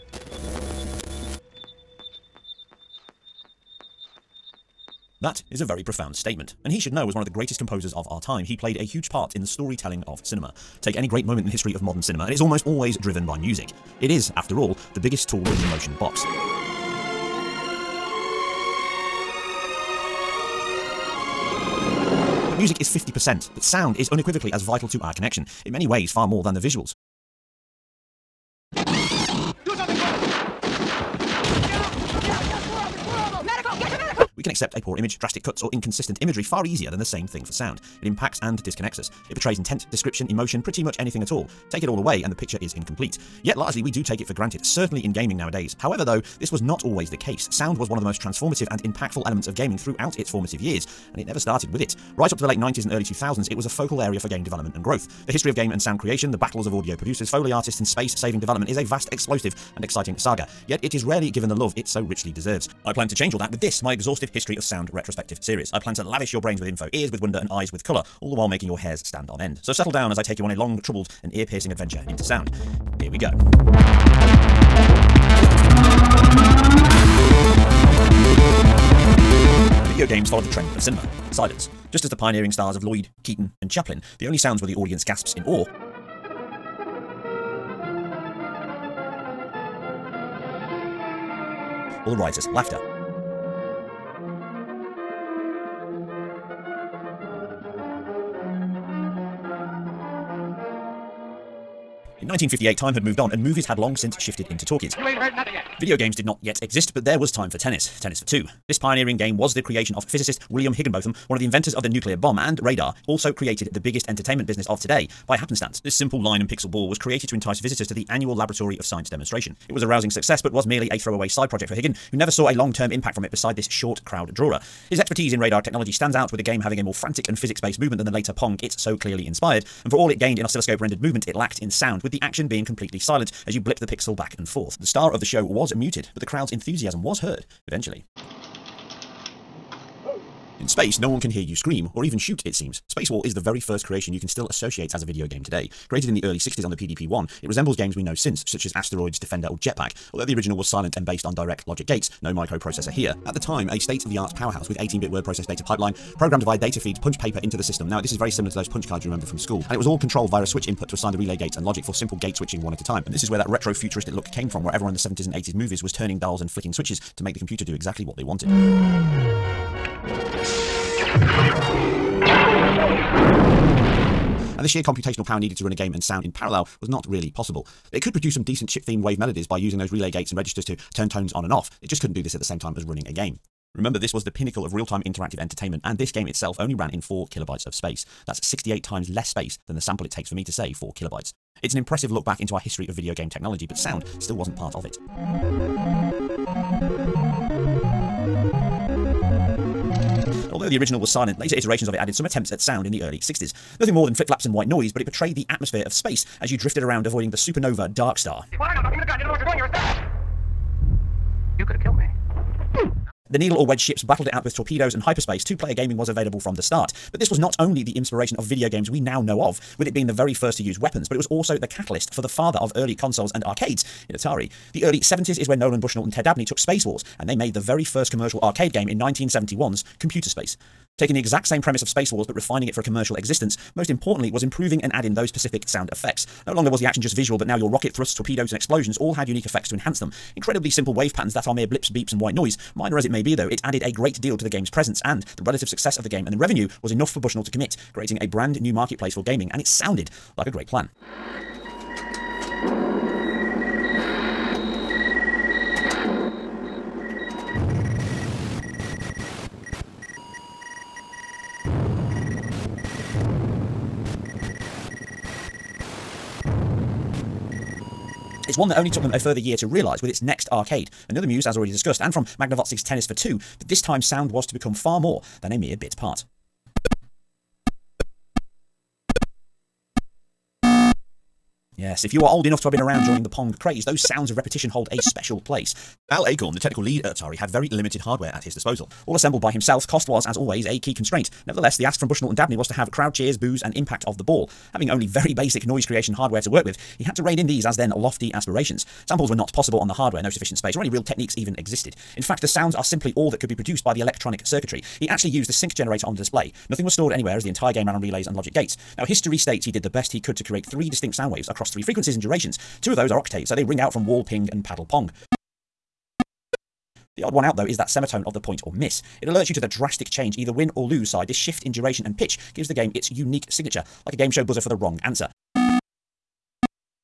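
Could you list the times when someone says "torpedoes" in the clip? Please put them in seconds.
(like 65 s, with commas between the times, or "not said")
214 s, 238 s.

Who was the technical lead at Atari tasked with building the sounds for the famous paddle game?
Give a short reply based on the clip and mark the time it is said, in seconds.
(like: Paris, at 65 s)
Al Alcorn, at 286 s.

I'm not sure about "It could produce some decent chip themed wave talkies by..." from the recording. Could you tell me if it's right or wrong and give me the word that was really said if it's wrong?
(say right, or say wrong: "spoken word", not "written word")
wrong: "melodies", not "talkies".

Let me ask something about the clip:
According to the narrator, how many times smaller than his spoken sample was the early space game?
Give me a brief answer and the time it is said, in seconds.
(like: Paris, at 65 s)
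68, at 188 s.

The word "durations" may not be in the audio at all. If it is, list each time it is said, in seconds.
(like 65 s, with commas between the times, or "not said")
312 s, 321 s.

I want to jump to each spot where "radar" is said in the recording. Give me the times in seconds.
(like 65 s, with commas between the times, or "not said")
112 s, 125 s.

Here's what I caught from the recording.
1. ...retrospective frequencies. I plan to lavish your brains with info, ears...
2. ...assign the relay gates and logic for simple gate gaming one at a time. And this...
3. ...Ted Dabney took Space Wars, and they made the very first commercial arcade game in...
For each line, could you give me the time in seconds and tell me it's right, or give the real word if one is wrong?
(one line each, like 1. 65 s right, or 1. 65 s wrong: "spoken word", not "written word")
1. 64 s wrong: "series", not "frequencies"
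2. 160 s wrong: "switching", not "gaming"
3. 226 s right.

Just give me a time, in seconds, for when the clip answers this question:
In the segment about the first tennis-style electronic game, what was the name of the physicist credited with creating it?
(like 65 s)
110 s.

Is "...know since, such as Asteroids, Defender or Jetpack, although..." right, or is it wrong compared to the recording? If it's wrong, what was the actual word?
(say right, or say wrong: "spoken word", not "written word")
right.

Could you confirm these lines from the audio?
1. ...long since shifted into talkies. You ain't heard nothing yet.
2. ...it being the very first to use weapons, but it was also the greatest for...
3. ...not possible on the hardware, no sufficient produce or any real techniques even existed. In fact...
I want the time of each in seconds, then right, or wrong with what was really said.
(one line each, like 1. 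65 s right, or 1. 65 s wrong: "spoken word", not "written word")
1. 103 s right
2. 219 s wrong: "catalyst", not "greatest"
3. 299 s wrong: "space", not "produce".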